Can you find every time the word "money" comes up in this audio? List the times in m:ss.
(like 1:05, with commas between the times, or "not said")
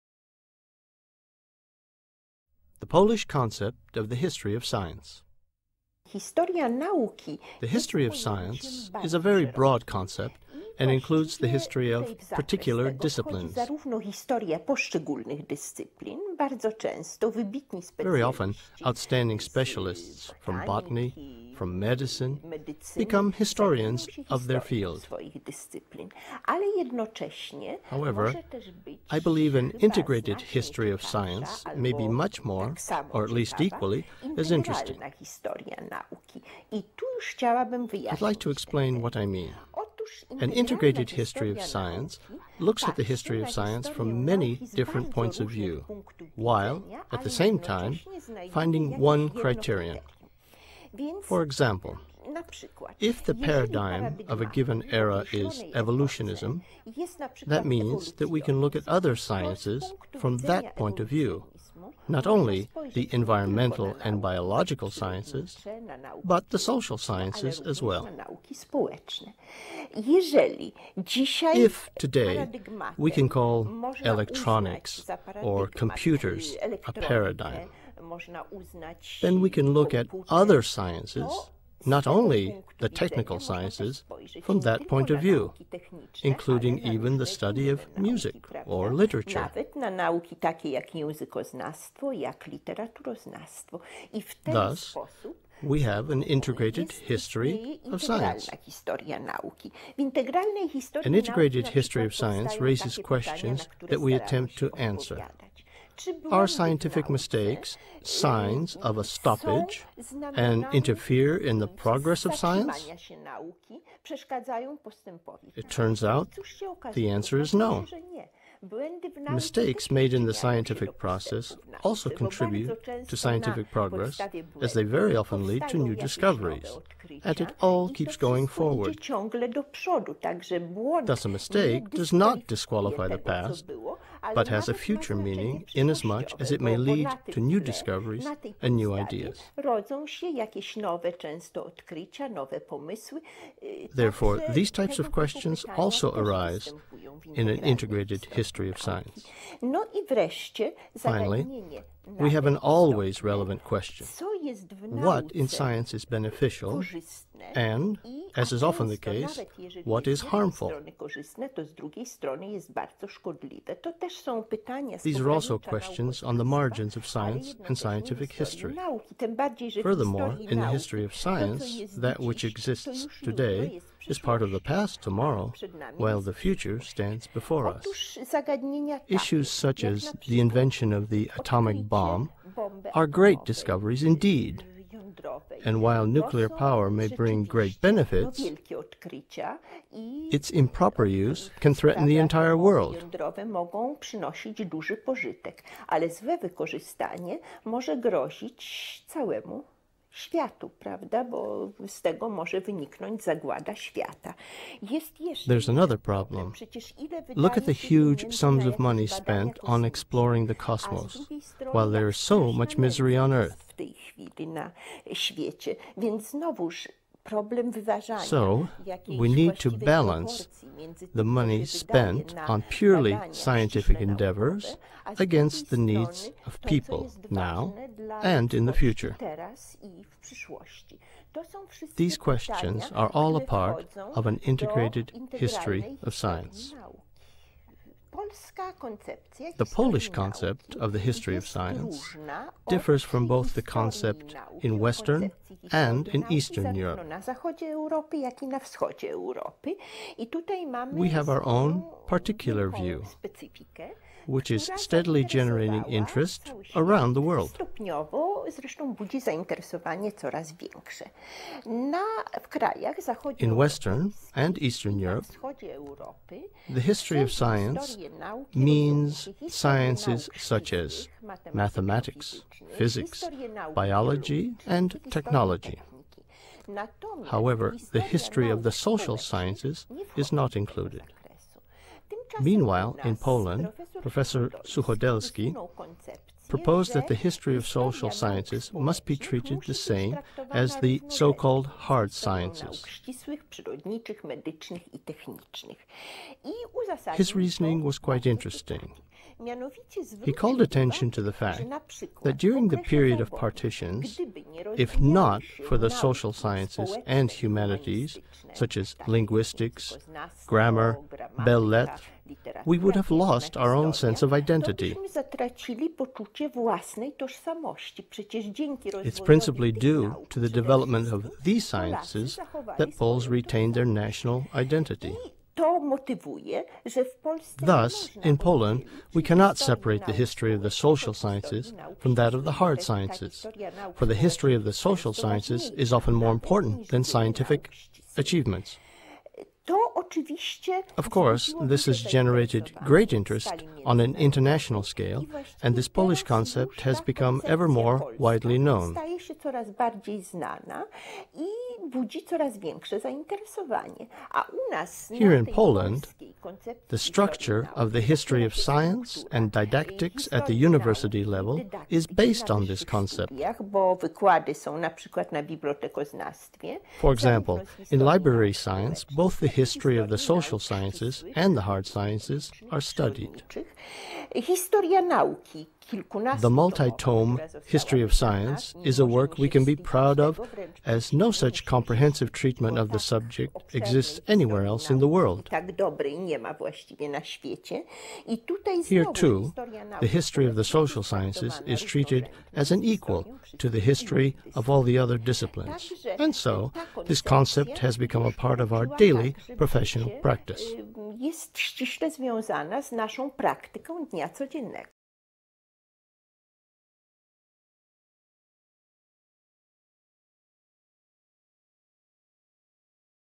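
3:28, 3:41.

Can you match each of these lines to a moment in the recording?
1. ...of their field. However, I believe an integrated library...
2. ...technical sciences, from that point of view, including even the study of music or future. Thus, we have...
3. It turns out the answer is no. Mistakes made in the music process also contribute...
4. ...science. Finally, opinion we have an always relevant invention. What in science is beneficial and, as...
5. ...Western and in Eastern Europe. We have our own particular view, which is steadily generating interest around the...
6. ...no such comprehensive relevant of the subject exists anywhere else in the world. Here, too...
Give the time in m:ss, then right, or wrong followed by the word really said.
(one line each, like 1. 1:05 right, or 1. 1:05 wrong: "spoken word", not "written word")
1. 0:24 wrong: "history", not "library"
2. 1:22 wrong: "literature", not "future"
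3. 1:55 wrong: "scientific", not "music"
4. 2:28 wrong: "question", not "invention"
5. 4:04 right
6. 6:21 wrong: "treatment", not "relevant".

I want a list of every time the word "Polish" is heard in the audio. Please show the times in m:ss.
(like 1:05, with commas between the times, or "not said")
0:02, 3:59, 5:45.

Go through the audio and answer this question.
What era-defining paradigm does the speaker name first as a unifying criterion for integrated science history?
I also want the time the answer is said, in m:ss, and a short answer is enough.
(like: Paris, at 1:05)
evolutionism, at 0:55.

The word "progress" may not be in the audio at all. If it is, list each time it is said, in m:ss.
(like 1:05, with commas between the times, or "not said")
1:51, 2:03.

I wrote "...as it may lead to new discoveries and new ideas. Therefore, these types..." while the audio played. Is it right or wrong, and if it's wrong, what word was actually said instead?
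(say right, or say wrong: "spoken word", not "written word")
right.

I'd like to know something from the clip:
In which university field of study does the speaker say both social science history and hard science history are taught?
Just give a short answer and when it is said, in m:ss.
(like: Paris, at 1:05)
library science, at 6:07.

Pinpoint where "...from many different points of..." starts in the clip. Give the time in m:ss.
0:43.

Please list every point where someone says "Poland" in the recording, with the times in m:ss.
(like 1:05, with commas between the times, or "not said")
4:43, 5:28, 5:55.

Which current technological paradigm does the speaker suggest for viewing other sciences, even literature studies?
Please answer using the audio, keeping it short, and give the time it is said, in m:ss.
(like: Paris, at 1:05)
electronics or computers, at 1:14.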